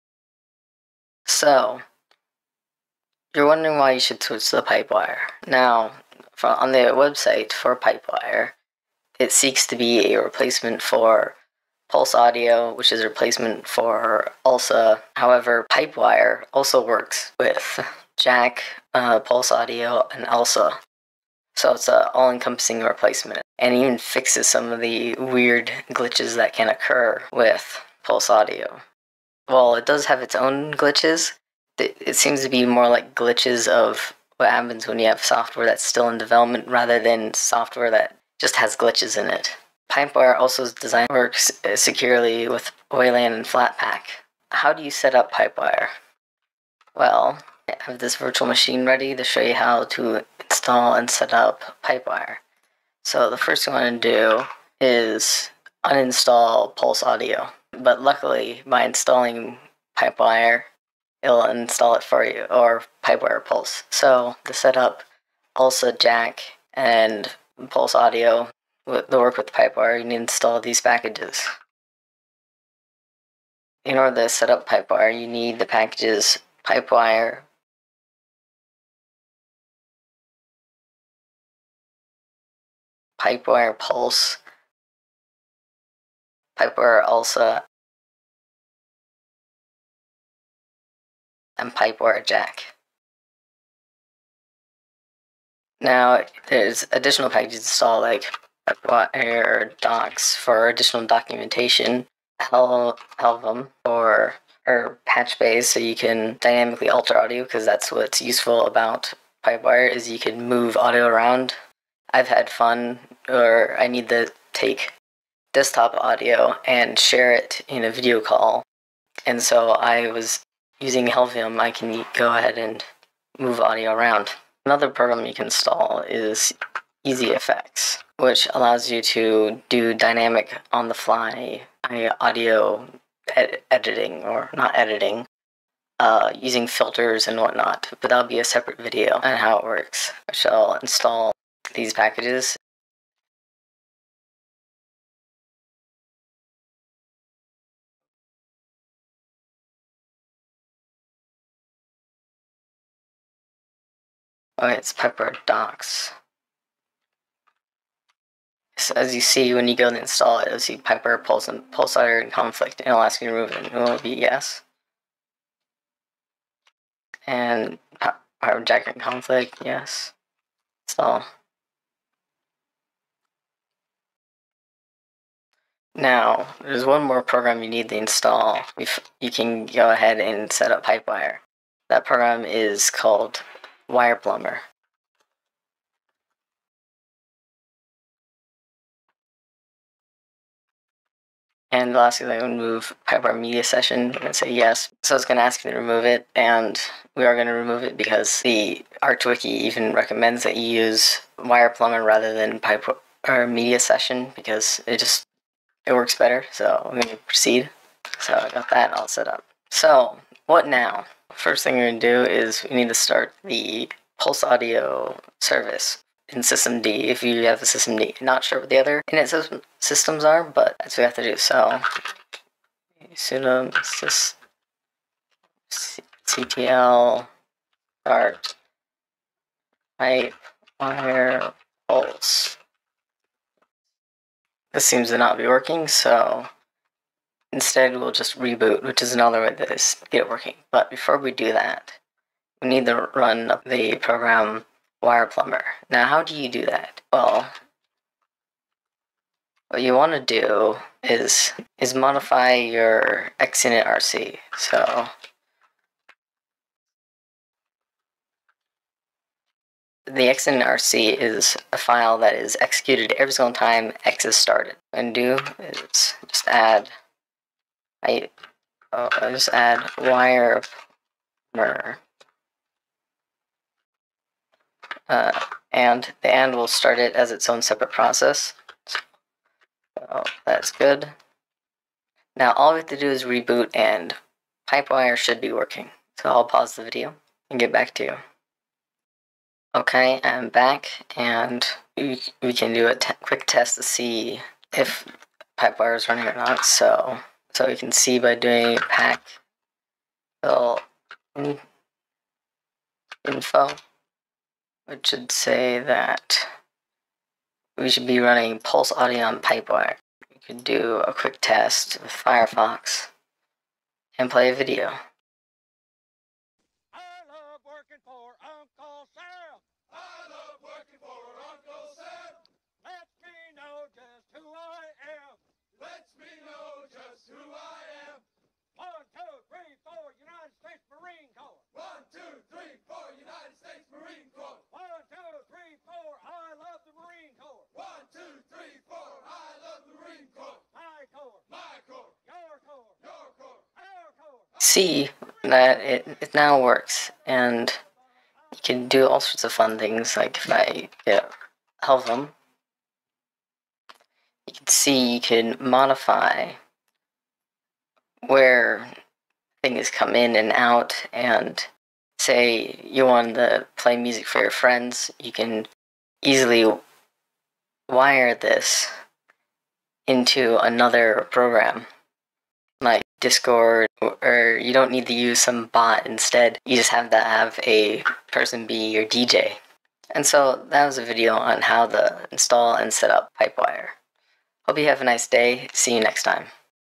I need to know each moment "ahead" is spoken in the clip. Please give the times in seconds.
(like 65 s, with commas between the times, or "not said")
122 s, 179 s.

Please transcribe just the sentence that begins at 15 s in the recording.
However, PipeWire also works with Jack, uh, Pulse Audio, and ALSA.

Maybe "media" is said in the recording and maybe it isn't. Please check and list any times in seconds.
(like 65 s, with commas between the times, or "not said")
193 s, 203 s.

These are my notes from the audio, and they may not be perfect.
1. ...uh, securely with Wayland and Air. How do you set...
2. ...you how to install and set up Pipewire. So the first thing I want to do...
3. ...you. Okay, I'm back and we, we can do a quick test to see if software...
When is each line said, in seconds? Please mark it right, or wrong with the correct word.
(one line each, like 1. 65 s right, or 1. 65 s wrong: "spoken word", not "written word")
1. 41 s wrong: "Flatpak", not "Air"
2. 49 s right
3. 288 s wrong: "pipewire", not "software".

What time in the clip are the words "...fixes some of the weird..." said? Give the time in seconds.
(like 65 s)
23 s.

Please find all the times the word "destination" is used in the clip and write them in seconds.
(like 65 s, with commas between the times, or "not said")
not said.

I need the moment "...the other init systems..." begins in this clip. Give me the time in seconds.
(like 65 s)
218 s.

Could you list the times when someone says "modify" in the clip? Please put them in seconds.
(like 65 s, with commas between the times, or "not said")
251 s, 355 s.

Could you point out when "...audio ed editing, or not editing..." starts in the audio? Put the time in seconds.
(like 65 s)
132 s.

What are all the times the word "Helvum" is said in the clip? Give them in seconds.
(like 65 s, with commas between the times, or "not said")
103 s, 121 s, 351 s.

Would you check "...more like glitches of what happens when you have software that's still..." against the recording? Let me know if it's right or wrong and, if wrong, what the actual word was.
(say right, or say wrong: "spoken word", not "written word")
right.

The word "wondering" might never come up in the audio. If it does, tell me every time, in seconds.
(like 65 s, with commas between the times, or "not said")
3 s.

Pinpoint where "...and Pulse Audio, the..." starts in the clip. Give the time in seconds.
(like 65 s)
66 s.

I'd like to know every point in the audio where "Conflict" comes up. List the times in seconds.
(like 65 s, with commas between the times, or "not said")
162 s, 168 s.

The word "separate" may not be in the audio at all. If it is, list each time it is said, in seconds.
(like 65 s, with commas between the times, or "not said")
138 s, 277 s.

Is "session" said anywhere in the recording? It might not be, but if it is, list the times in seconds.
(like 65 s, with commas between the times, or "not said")
193 s, 203 s.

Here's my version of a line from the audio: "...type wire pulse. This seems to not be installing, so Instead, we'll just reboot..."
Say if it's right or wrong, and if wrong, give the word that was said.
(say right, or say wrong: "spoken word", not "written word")
wrong: "working", not "installing".